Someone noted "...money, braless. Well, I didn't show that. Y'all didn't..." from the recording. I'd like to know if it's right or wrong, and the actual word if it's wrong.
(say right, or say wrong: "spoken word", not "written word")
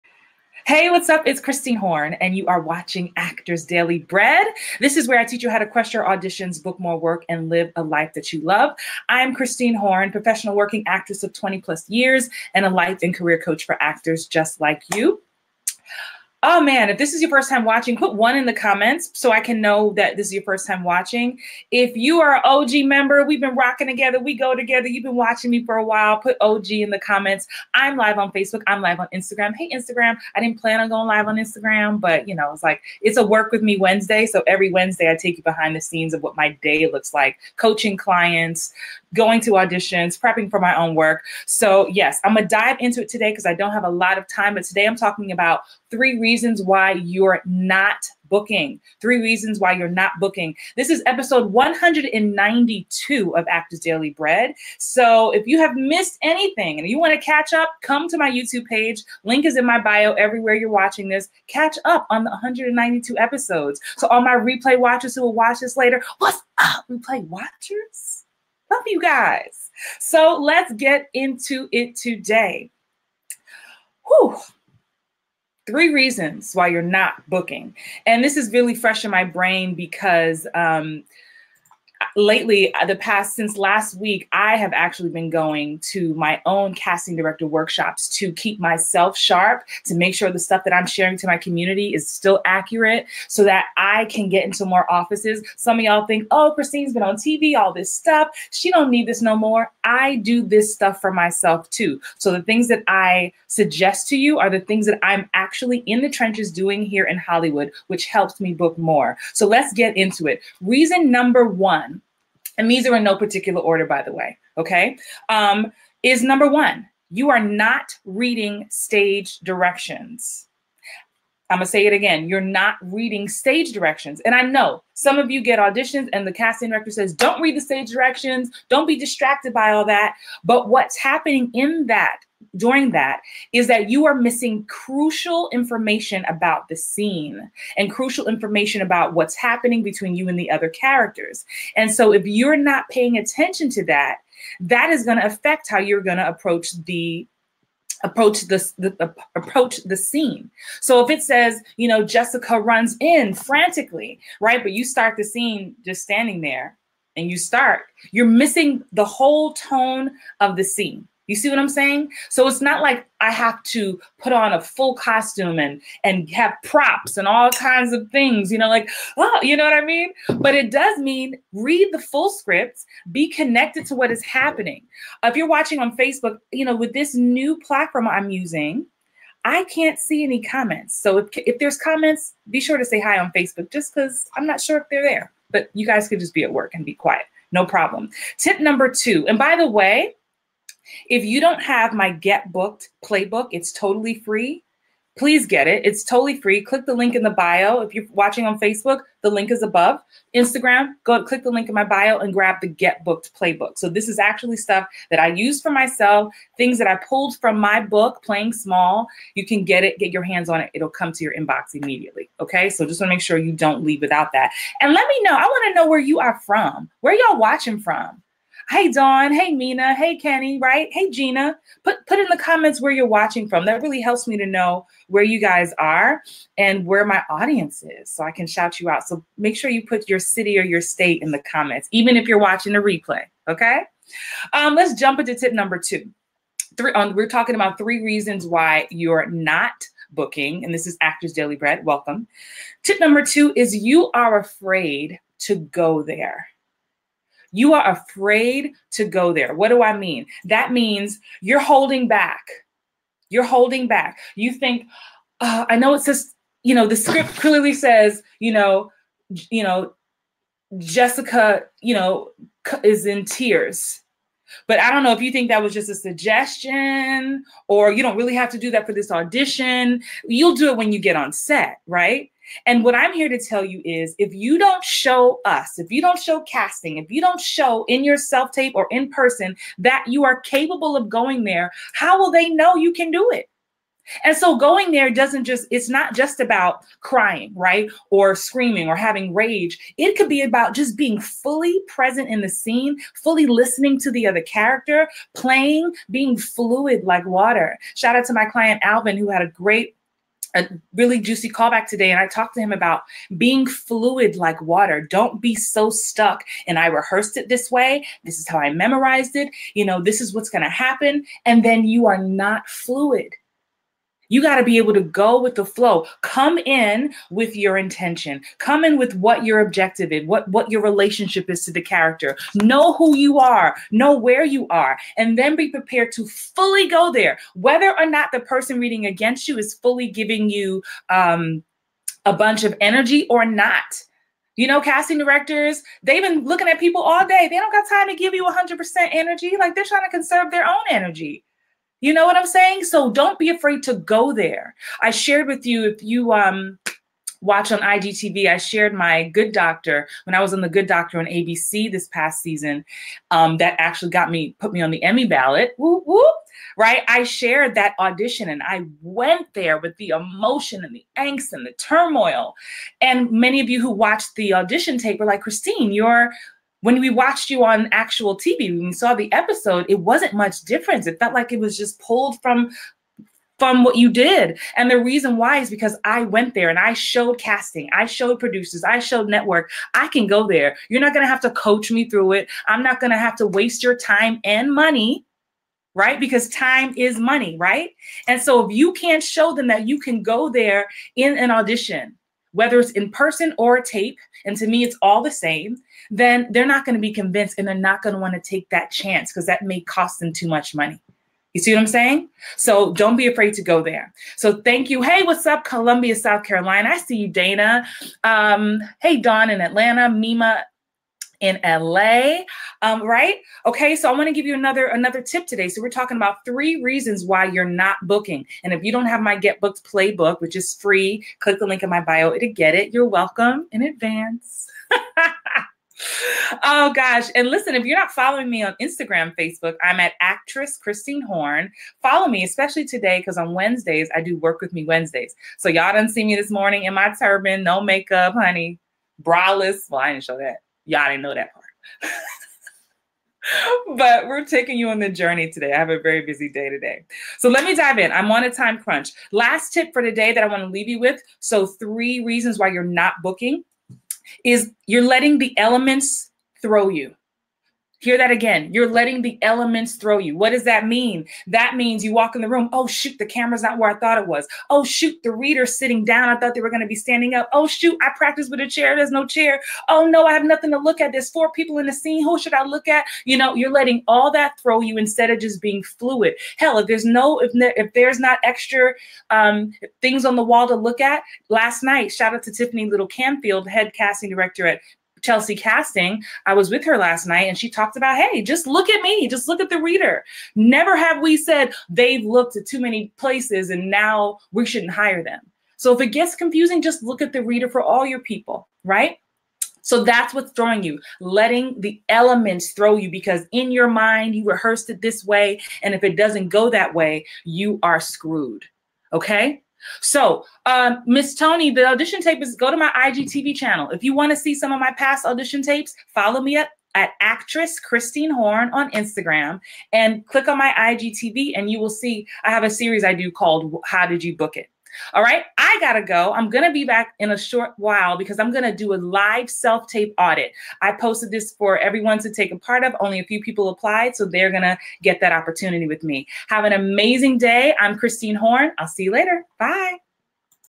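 wrong: "honey", not "money".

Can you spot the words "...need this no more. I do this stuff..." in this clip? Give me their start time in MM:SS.
01:38.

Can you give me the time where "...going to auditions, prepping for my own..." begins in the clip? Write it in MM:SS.
00:39.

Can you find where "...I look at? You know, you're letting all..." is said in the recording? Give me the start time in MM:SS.
07:52.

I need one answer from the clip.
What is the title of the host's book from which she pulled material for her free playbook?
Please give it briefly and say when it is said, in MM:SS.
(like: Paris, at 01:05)
Playing Small, at 03:28.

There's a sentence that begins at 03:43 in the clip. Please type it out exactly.
That really helps me to know where you guys are and where my audience is so I can shout you out.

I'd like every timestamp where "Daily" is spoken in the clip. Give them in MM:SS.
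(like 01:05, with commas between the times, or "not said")
00:03, 00:53, 04:01.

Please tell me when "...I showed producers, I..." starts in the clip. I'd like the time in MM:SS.
06:17.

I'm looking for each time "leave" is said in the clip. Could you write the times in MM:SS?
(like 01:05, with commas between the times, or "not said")
03:33, 07:30.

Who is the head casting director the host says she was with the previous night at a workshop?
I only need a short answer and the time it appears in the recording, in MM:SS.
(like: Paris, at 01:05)
Tiffany Little Canfield, at 08:02.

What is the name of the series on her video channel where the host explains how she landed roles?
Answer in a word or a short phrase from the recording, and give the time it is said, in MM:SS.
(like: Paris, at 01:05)
How Did You Book It?, at 08:43.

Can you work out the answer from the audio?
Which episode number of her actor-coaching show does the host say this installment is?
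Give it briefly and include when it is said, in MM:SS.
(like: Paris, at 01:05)
192, at 00:51.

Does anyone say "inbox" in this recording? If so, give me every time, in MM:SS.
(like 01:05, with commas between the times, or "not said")
03:31.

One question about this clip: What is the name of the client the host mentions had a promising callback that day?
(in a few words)
Alvin.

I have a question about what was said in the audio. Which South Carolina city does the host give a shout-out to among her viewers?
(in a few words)
Columbia.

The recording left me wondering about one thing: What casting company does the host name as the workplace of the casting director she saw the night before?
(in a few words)
Telsey Casting.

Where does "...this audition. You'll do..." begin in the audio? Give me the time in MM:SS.
04:28.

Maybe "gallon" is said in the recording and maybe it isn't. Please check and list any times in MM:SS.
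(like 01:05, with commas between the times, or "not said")
not said.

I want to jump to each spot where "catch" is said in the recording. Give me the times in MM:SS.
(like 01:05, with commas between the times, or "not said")
00:57, 01:01.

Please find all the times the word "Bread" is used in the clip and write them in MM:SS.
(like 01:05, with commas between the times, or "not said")
00:03, 00:54, 04:01.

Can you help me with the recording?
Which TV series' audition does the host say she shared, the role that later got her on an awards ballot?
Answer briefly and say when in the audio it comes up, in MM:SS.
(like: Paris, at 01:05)
The Good Doctor, at 05:50.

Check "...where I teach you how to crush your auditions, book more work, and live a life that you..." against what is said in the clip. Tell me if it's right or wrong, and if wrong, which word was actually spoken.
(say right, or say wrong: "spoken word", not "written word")
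right.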